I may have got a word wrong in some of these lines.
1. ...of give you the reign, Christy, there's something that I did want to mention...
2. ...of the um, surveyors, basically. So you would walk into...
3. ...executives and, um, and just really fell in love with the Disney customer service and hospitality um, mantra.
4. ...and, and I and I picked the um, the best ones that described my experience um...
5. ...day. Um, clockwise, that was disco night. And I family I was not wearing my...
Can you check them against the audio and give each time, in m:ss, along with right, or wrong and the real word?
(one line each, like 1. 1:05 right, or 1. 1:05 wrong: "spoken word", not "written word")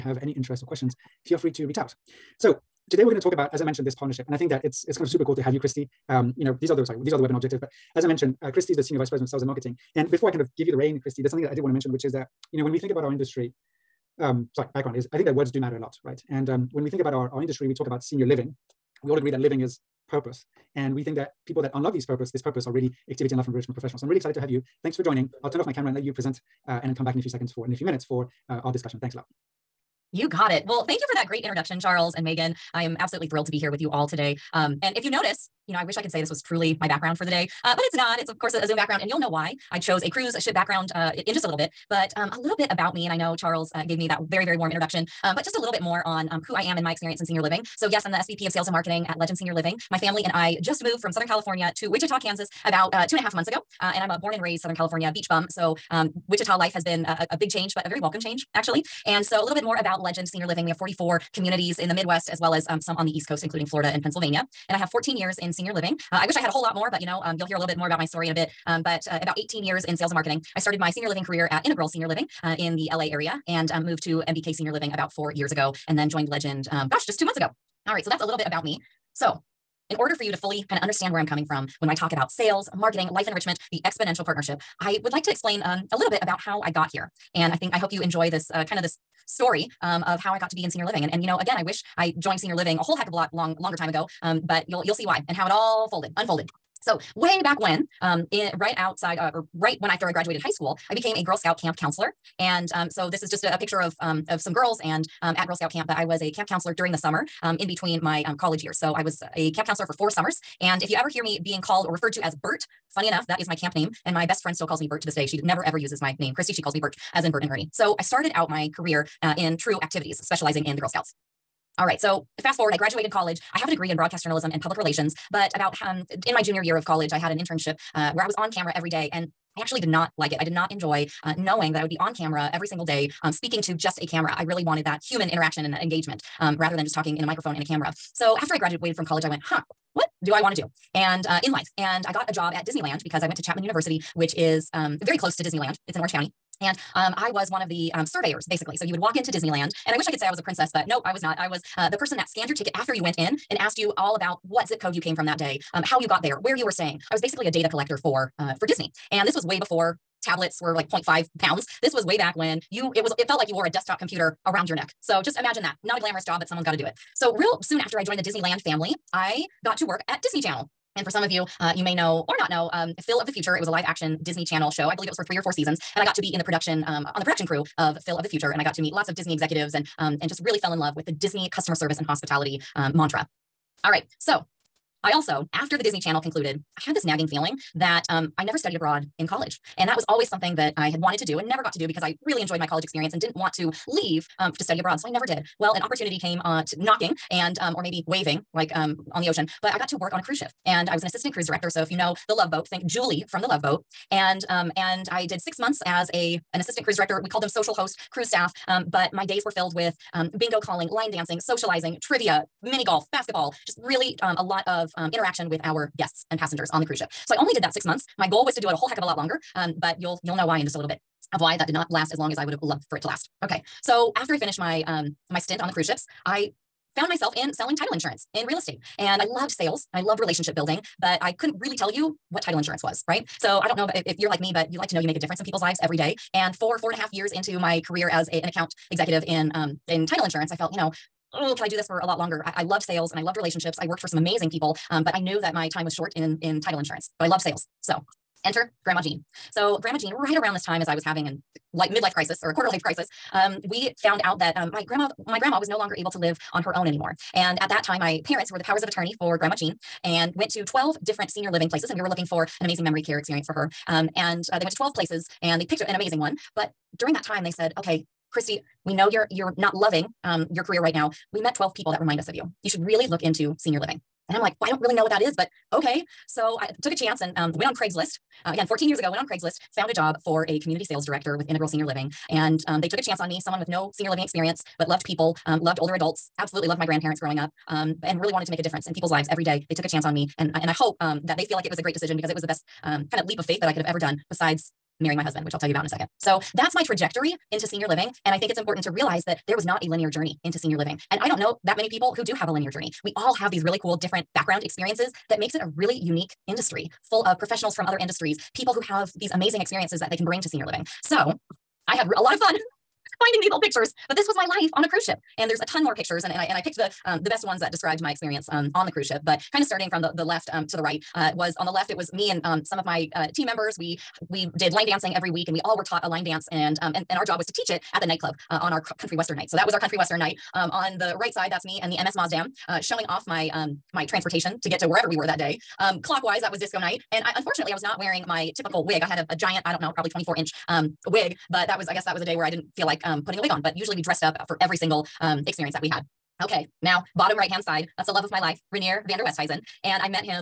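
1. 0:10 right
2. 2:27 right
3. 2:59 right
4. 5:16 right
5. 5:35 wrong: "unfortunately", not "family".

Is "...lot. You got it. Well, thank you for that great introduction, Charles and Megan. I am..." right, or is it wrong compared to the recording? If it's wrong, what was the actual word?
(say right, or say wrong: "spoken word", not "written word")
right.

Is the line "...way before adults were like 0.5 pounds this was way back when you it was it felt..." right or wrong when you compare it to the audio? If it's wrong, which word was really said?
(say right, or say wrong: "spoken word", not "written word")
wrong: "tablets", not "adults".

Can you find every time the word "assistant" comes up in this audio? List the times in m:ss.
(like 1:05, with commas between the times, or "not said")
3:21, 3:26.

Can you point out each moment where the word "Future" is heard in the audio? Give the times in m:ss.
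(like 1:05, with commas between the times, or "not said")
2:53, 2:58.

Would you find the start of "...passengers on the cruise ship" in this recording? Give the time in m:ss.
3:36.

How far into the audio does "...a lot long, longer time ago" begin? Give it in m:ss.
1:33.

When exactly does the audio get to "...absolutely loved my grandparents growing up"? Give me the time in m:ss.
4:46.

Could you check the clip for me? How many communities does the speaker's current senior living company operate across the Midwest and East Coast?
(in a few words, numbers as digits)
44.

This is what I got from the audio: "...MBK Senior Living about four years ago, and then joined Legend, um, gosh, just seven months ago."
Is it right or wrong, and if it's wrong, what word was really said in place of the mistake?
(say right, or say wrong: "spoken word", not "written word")
wrong: "two", not "seven".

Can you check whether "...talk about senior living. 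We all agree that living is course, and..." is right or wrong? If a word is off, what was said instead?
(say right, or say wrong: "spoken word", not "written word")
wrong: "purpose", not "course".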